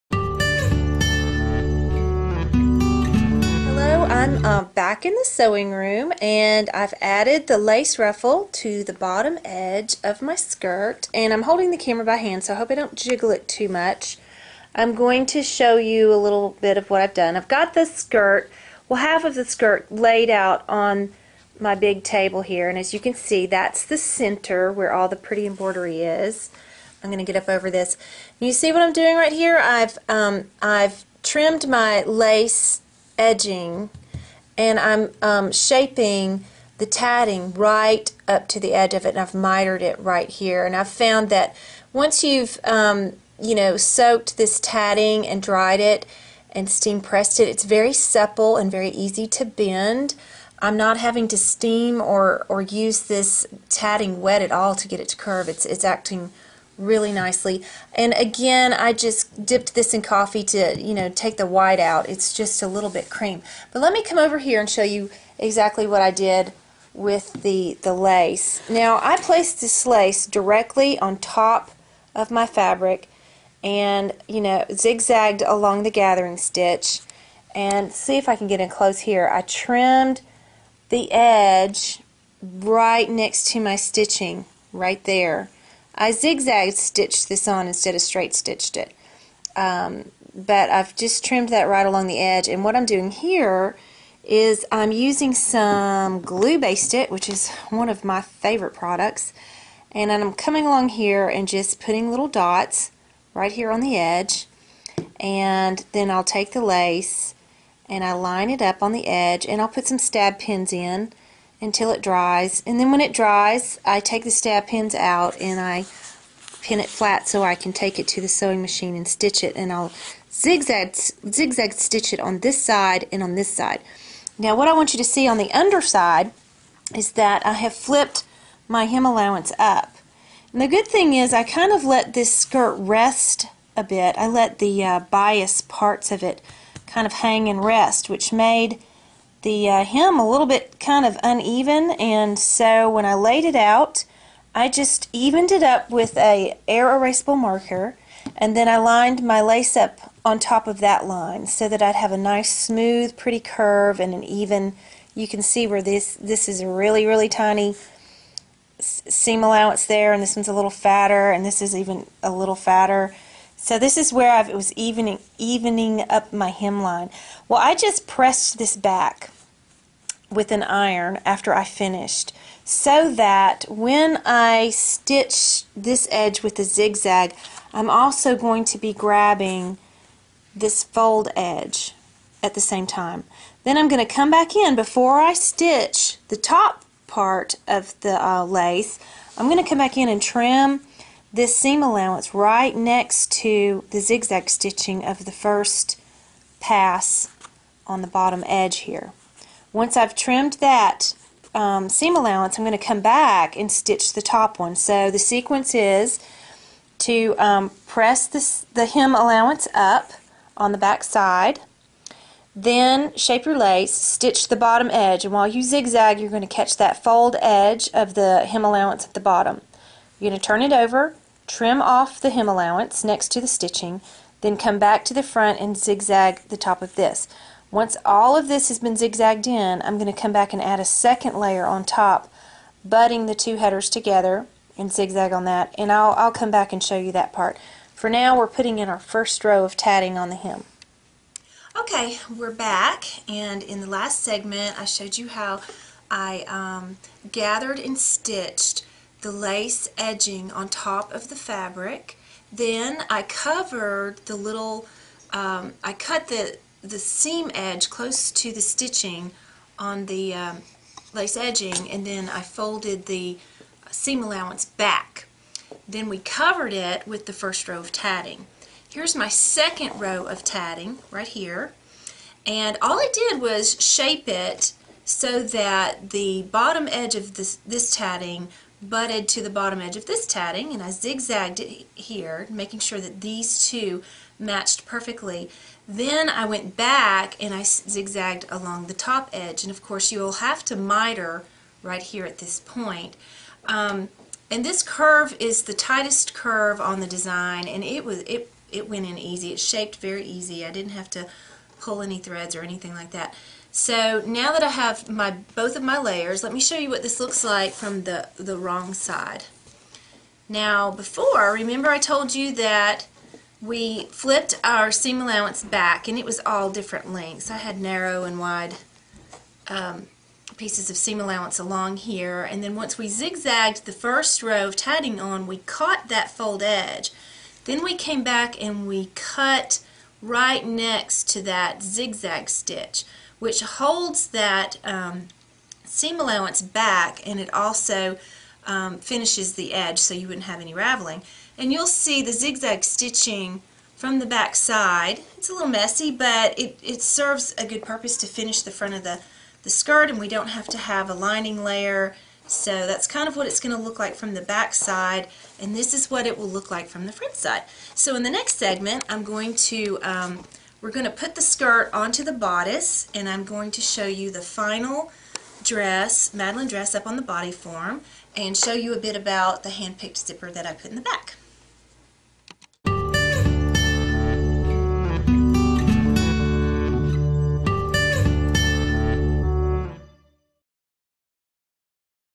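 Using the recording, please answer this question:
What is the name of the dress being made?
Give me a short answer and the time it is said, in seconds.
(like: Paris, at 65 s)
Madelyn, at 366 s.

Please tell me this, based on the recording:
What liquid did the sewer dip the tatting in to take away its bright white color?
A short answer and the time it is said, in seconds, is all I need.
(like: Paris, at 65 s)
Coffee, at 60 s.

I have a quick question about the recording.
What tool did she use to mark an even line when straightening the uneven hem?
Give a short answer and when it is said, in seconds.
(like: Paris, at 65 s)
Air erasable marker, at 146 s.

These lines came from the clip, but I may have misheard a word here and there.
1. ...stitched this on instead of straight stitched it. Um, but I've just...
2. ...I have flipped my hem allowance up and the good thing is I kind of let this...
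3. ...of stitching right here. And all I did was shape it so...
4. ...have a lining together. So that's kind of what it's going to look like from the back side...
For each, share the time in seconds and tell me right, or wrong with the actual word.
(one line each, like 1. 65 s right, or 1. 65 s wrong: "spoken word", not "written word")
1. 86 s right
2. 127 s right
3. 270 s wrong: "tatting", not "stitching"
4. 350 s wrong: "layer", not "together".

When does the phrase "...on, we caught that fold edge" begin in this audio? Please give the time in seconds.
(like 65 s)
325 s.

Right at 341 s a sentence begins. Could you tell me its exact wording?
And you'll see the zigzag stitching from the back side.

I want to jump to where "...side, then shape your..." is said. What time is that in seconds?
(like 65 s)
211 s.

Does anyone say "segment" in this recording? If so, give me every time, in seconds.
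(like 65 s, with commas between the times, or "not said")
244 s, 358 s.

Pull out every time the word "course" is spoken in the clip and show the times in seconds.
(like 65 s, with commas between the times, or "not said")
289 s.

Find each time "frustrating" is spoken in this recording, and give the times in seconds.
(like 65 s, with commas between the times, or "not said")
not said.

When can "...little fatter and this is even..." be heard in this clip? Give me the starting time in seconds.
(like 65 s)
160 s.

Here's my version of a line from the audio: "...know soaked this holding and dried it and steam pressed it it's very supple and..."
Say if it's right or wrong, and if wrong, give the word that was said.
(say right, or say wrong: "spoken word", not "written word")
wrong: "tatting", not "holding".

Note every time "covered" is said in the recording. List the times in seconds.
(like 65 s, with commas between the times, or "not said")
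253 s, 266 s.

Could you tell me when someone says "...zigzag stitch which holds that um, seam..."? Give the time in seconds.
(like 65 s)
331 s.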